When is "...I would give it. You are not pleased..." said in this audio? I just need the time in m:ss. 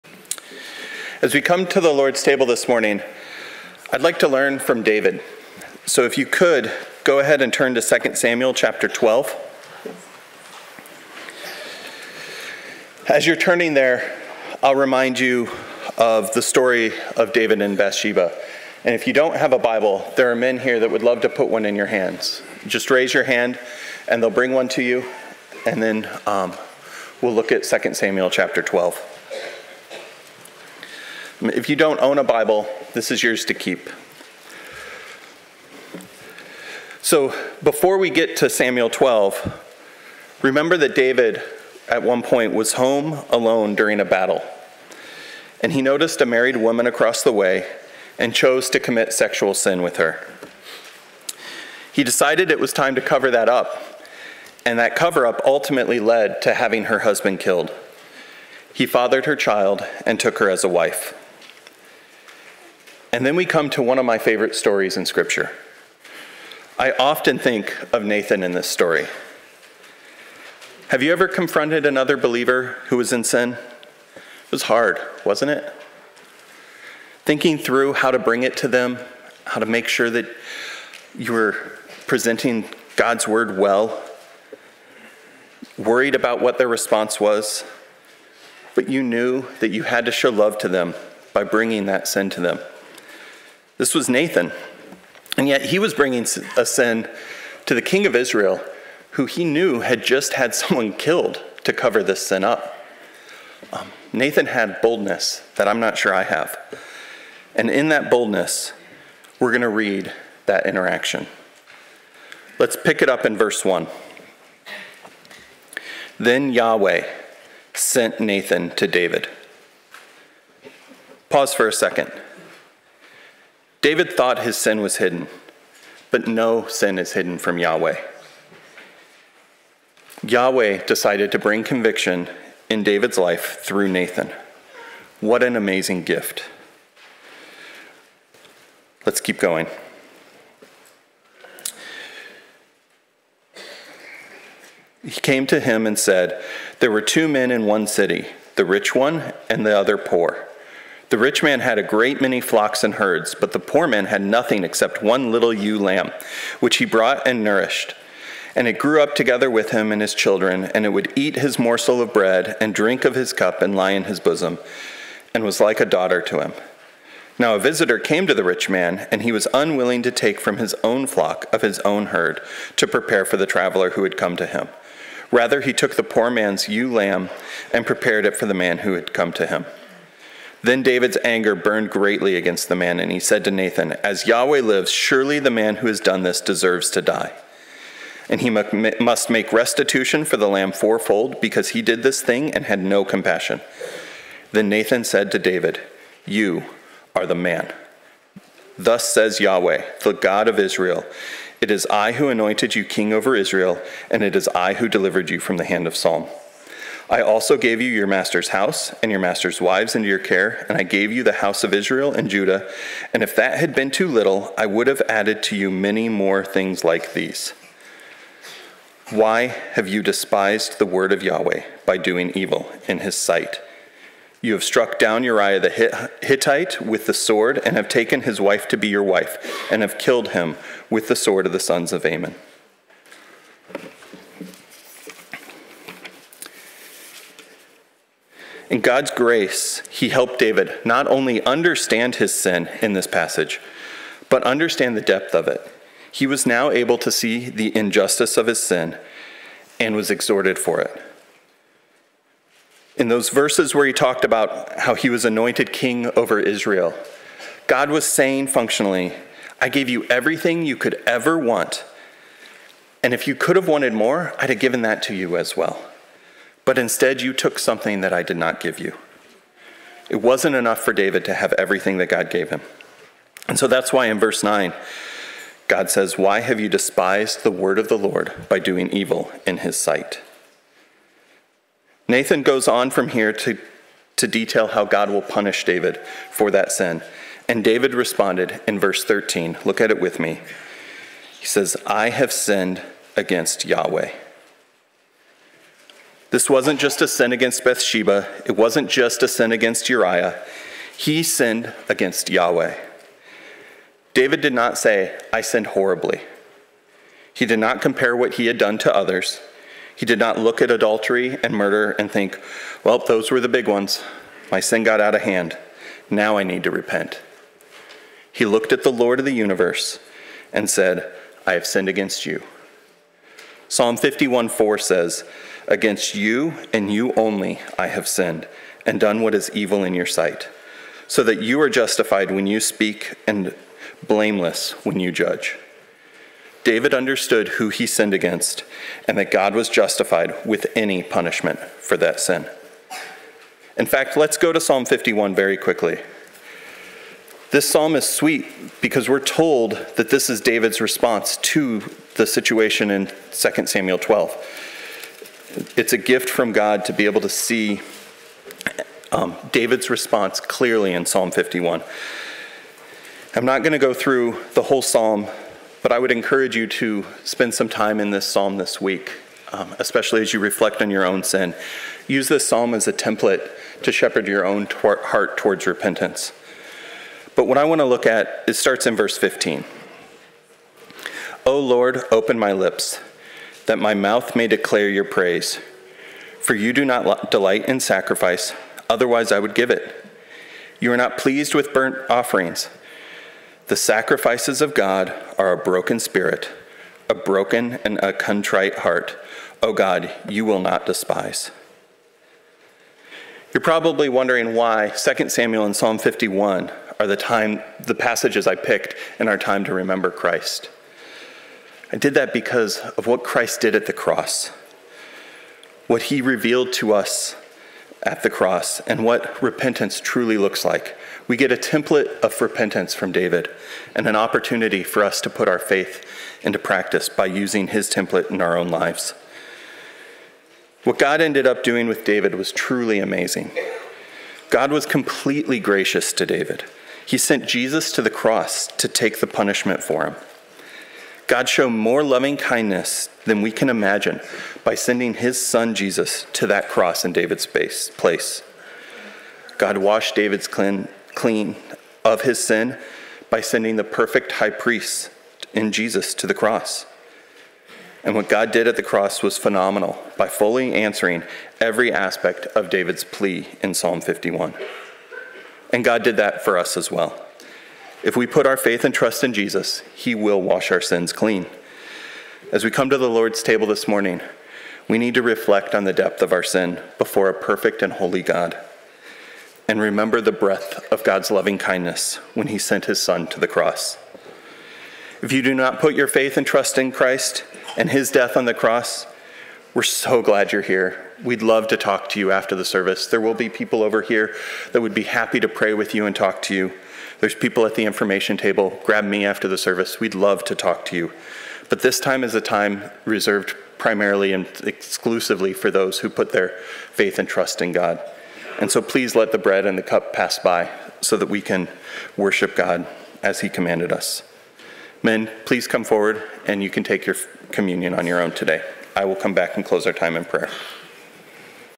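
6:29.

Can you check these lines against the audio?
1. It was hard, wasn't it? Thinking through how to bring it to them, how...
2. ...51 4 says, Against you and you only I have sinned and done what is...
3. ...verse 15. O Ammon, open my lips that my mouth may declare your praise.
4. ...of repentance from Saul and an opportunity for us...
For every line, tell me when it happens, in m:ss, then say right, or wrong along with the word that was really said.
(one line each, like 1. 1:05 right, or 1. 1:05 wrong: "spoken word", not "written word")
1. 1:14 right
2. 5:23 right
3. 6:18 wrong: "Lord", not "Ammon"
4. 7:02 wrong: "David", not "Saul".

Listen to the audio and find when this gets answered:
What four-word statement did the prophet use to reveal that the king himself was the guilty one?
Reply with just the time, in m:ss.
3:16.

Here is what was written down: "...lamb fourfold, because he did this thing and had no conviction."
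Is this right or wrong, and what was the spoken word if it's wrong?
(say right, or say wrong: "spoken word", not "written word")
wrong: "compassion", not "conviction".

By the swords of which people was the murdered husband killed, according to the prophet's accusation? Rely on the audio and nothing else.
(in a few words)
the sons of Ammon.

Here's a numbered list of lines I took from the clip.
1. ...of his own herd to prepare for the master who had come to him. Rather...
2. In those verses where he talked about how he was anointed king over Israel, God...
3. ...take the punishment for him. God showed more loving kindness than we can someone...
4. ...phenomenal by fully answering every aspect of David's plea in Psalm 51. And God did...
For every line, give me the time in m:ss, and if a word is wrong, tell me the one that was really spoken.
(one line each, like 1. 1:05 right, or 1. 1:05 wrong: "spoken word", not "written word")
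1. 2:51 wrong: "traveler", not "master"
2. 4:12 right
3. 7:18 wrong: "imagine", not "someone"
4. 7:39 right.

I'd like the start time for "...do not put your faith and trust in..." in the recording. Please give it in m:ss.
8:05.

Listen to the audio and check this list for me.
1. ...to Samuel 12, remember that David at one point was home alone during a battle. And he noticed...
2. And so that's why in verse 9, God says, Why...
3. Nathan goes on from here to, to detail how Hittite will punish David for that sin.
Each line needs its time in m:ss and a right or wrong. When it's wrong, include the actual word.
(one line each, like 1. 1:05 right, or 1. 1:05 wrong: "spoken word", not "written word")
1. 0:38 right
2. 4:33 right
3. 4:42 wrong: "God", not "Hittite".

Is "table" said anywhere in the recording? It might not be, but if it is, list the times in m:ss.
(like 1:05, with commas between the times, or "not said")
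0:02, 7:53, 8:18.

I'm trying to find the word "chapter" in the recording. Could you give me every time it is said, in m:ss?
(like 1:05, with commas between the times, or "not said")
0:08, 0:28.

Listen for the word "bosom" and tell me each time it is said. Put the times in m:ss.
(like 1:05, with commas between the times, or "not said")
2:44.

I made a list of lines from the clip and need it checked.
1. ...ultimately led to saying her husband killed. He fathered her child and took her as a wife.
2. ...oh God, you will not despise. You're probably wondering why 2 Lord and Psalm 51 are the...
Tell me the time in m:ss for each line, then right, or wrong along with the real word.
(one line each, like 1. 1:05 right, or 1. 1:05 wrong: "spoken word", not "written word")
1. 0:55 wrong: "having", not "saying"
2. 6:39 wrong: "Samuel", not "Lord".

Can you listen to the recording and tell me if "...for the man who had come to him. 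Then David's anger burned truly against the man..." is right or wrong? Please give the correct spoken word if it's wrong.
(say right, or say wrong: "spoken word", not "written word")
wrong: "greatly", not "truly".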